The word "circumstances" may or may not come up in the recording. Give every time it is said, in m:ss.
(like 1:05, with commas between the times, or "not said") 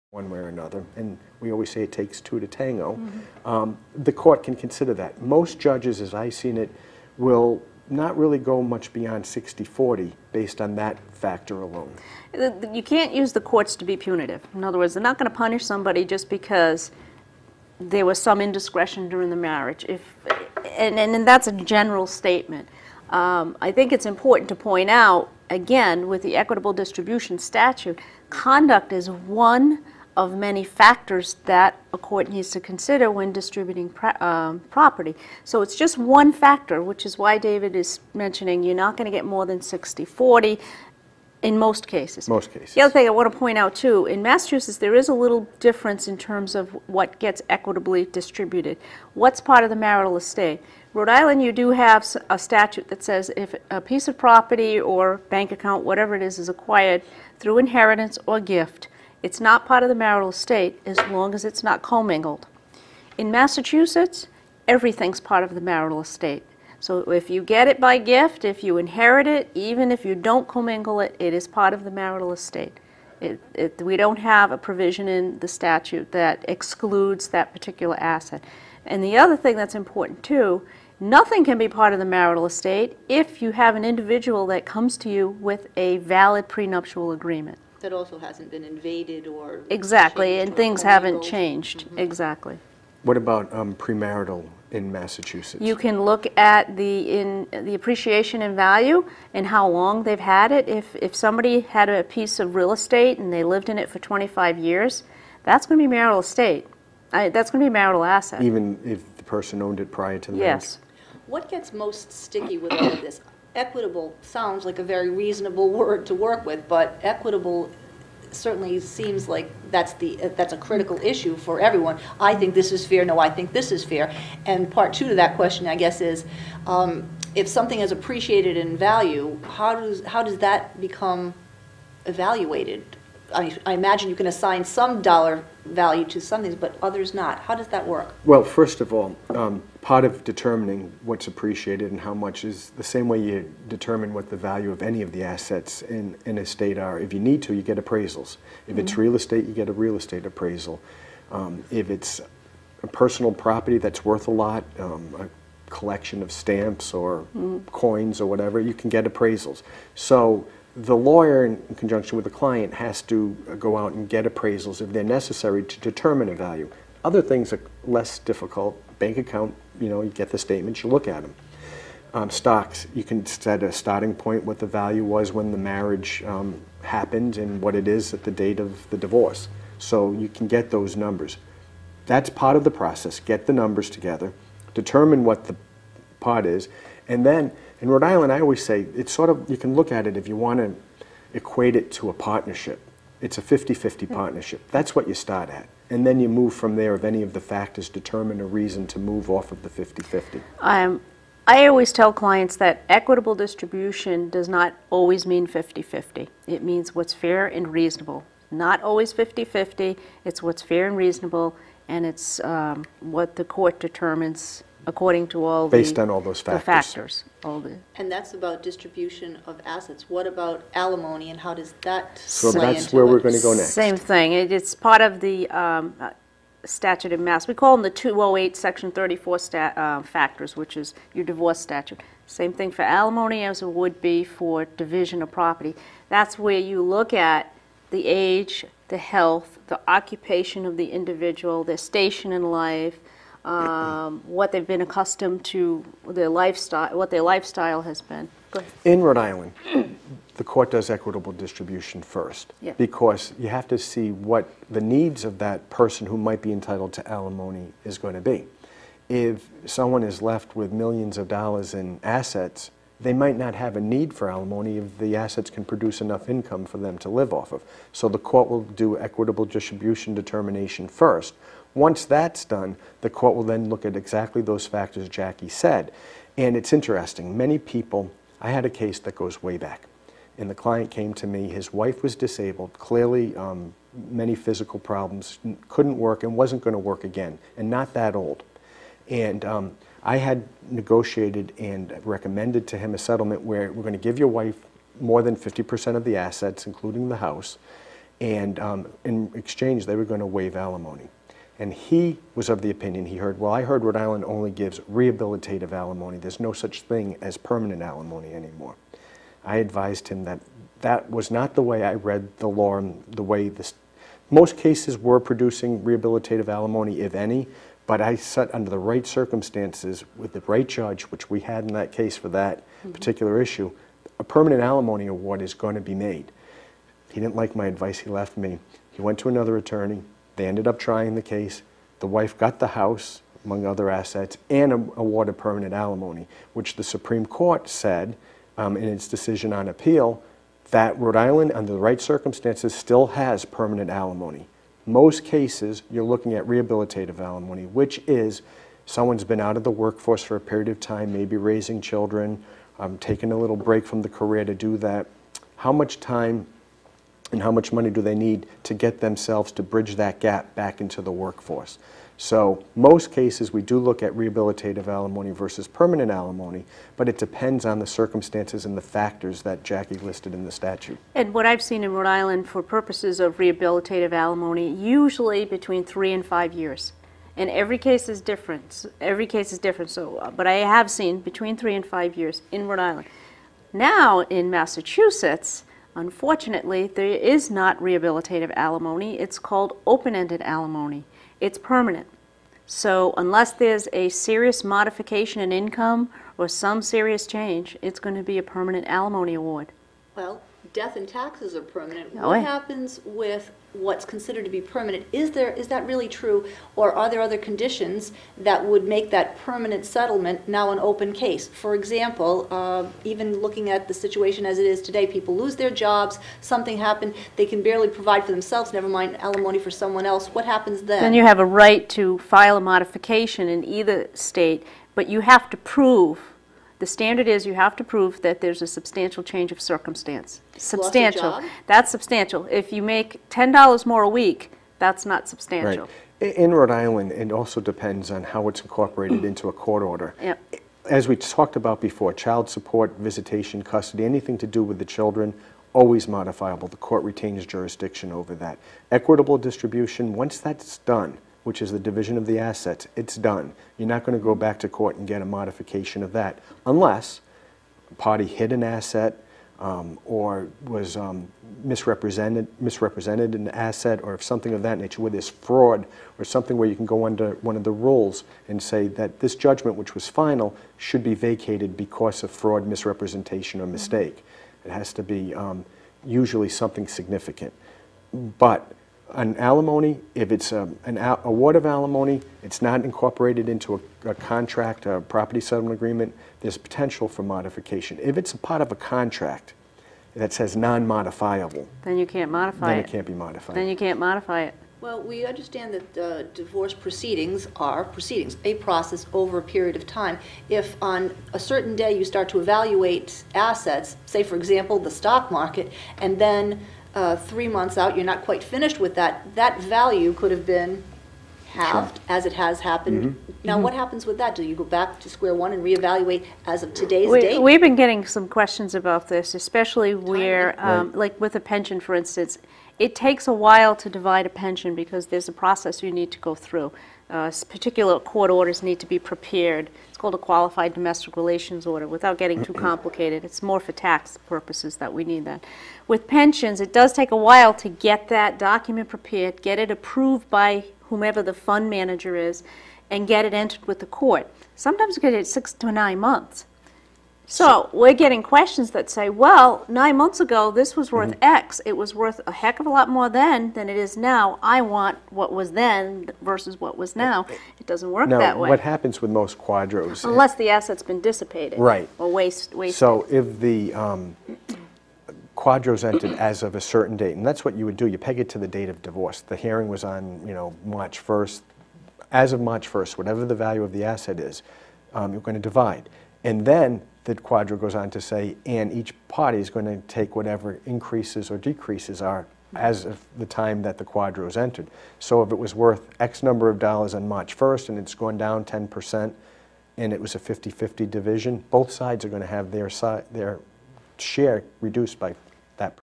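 5:19, 5:41, 6:07, 7:09.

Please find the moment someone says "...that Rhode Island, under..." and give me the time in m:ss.
5:40.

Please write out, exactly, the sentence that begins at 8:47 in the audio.
Uh, particular court orders need to be prepared.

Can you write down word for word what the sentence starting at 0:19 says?
If, and, and, and that's a general statement.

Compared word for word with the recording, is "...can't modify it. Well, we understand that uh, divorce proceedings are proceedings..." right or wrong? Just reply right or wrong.
right.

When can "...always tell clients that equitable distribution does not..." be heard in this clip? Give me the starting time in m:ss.
3:21.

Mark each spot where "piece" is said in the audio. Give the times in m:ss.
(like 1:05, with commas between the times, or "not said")
0:53, 1:42.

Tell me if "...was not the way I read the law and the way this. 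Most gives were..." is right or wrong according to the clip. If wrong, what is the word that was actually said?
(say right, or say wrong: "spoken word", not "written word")
wrong: "cases", not "gives".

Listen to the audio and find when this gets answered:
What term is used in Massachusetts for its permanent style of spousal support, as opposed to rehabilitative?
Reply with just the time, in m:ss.
6:29.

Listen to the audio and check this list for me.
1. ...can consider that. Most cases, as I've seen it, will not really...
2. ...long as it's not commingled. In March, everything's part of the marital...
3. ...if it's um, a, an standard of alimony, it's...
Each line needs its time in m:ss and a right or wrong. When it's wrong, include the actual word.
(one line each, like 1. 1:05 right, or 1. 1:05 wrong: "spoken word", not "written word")
1. 0:04 wrong: "judges", not "cases"
2. 1:01 wrong: "Massachusetts", not "March"
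3. 8:00 wrong: "award", not "standard".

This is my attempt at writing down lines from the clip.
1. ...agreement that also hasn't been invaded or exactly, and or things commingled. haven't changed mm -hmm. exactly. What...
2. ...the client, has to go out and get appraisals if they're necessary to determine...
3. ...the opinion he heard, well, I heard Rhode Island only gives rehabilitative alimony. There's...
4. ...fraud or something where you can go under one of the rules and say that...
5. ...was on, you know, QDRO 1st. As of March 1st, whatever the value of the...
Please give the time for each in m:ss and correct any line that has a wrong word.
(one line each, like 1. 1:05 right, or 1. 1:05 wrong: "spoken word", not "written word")
1. 1:27 right
2. 2:42 right
3. 5:02 right
4. 7:45 right
5. 9:29 wrong: "March", not "QDRO".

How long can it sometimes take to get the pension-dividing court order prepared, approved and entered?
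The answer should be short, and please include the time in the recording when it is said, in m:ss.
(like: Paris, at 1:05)
6 to 9 months, at 9:05.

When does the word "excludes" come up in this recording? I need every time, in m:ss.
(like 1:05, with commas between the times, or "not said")
1:16.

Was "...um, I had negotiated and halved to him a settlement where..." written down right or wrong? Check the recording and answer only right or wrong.
wrong.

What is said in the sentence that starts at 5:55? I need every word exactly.
How much time and how much money do they need to get themselves to bridge that gap back into the workforce.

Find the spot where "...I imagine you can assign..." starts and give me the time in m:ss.
2:13.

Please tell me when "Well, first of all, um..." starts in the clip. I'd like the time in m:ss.
2:18.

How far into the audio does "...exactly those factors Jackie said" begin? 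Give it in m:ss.
4:33.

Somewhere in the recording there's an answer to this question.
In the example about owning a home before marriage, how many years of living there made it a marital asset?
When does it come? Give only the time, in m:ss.
1:43.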